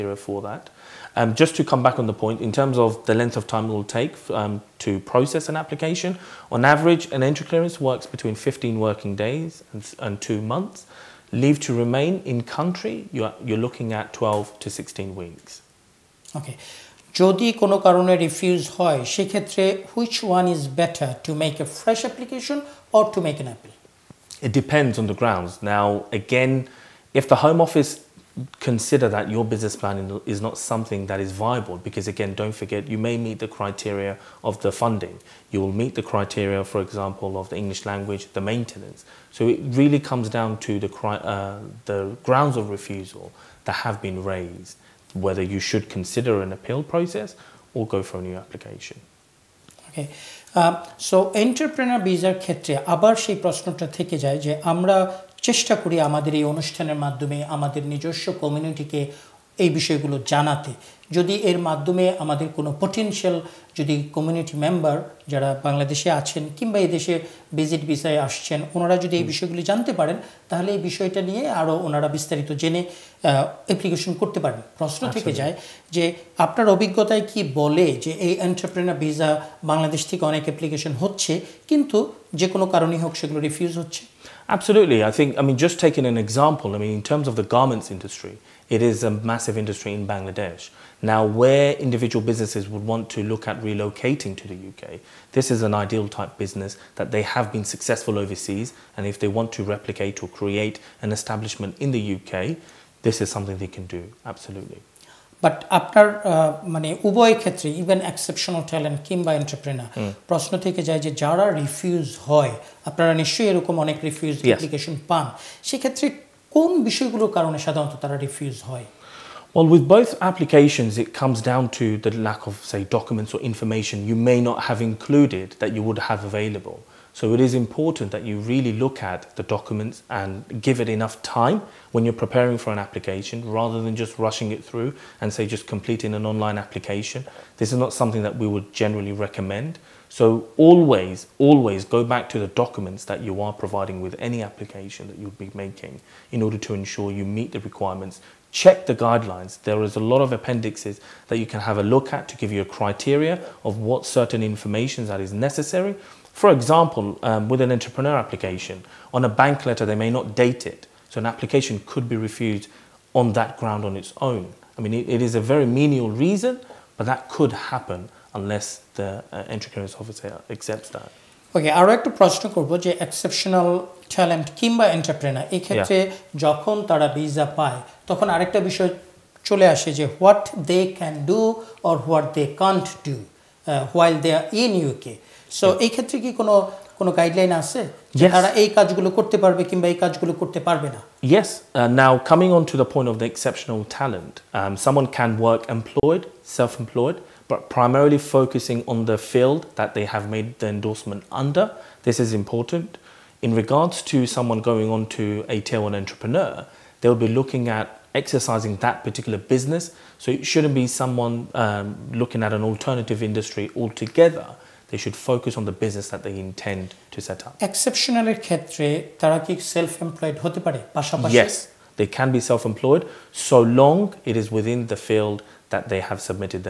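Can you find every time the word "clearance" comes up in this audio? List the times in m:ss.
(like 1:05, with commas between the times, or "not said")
0:07, 2:49.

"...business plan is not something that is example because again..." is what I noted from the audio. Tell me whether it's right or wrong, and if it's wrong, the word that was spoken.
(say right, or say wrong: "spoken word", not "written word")
wrong: "viable", not "example".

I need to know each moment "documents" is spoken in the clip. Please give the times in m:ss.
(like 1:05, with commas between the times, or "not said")
2:02, 2:09, 2:22.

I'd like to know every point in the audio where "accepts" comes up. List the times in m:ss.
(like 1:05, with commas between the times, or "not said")
2:50.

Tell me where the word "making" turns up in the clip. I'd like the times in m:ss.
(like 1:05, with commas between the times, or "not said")
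2:25.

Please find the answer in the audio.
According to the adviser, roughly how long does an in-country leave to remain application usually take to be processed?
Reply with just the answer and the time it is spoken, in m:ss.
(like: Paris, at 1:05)
12 to 16 weeks, at 0:14.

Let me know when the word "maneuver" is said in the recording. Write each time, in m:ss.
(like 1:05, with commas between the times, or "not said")
not said.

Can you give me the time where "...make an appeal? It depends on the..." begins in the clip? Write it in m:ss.
0:23.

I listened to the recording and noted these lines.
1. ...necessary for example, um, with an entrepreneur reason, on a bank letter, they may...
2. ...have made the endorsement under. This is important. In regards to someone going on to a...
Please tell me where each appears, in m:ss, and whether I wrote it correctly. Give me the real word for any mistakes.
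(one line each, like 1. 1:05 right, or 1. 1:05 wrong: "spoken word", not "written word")
1. 2:35 wrong: "application", not "reason"
2. 3:20 right.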